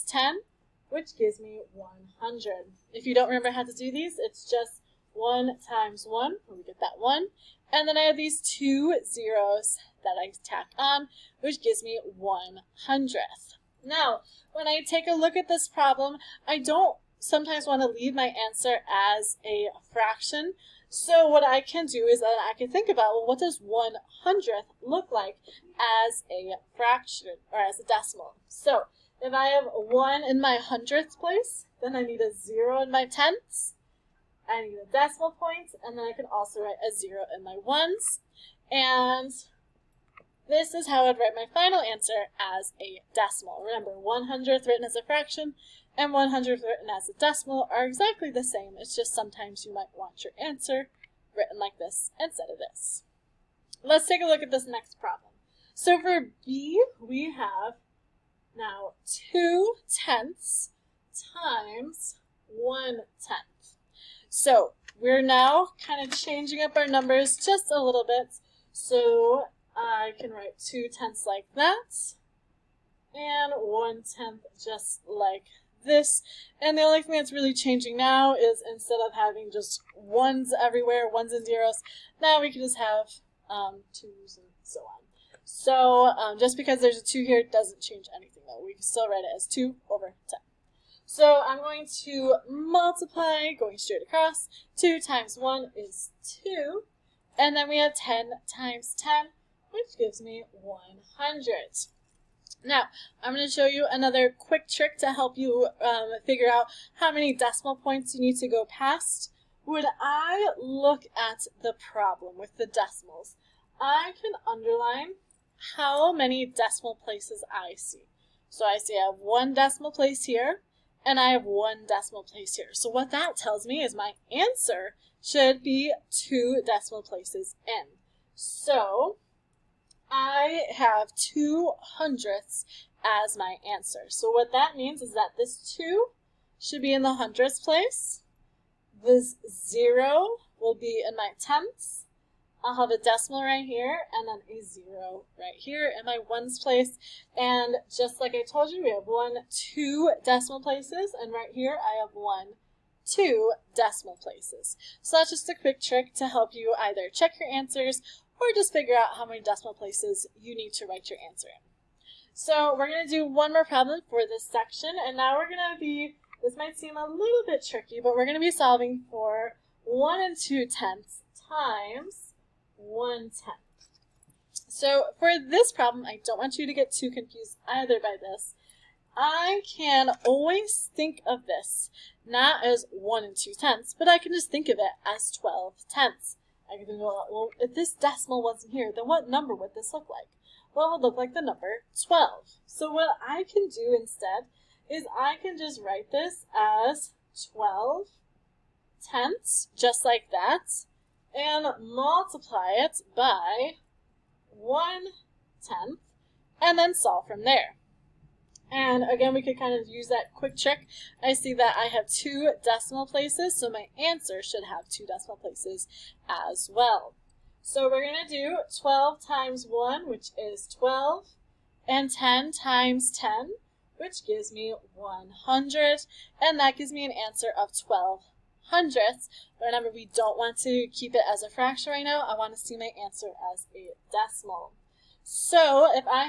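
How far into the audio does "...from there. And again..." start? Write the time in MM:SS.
03:27.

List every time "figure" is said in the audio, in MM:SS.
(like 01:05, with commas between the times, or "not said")
01:46, 02:38.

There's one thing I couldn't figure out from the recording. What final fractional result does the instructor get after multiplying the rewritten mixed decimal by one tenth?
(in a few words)
12 hundredths.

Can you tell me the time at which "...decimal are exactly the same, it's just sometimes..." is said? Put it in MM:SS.
00:47.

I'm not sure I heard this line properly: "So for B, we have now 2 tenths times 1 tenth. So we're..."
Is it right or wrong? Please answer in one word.
right.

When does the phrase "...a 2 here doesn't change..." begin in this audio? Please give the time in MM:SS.
01:26.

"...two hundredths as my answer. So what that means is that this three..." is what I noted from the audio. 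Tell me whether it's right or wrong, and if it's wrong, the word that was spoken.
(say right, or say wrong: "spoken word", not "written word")
wrong: "two", not "three".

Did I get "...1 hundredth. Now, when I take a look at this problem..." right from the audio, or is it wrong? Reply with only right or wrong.
right.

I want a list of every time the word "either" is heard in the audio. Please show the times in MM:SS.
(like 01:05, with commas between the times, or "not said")
02:36, 02:57.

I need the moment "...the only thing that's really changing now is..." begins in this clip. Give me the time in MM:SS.
01:16.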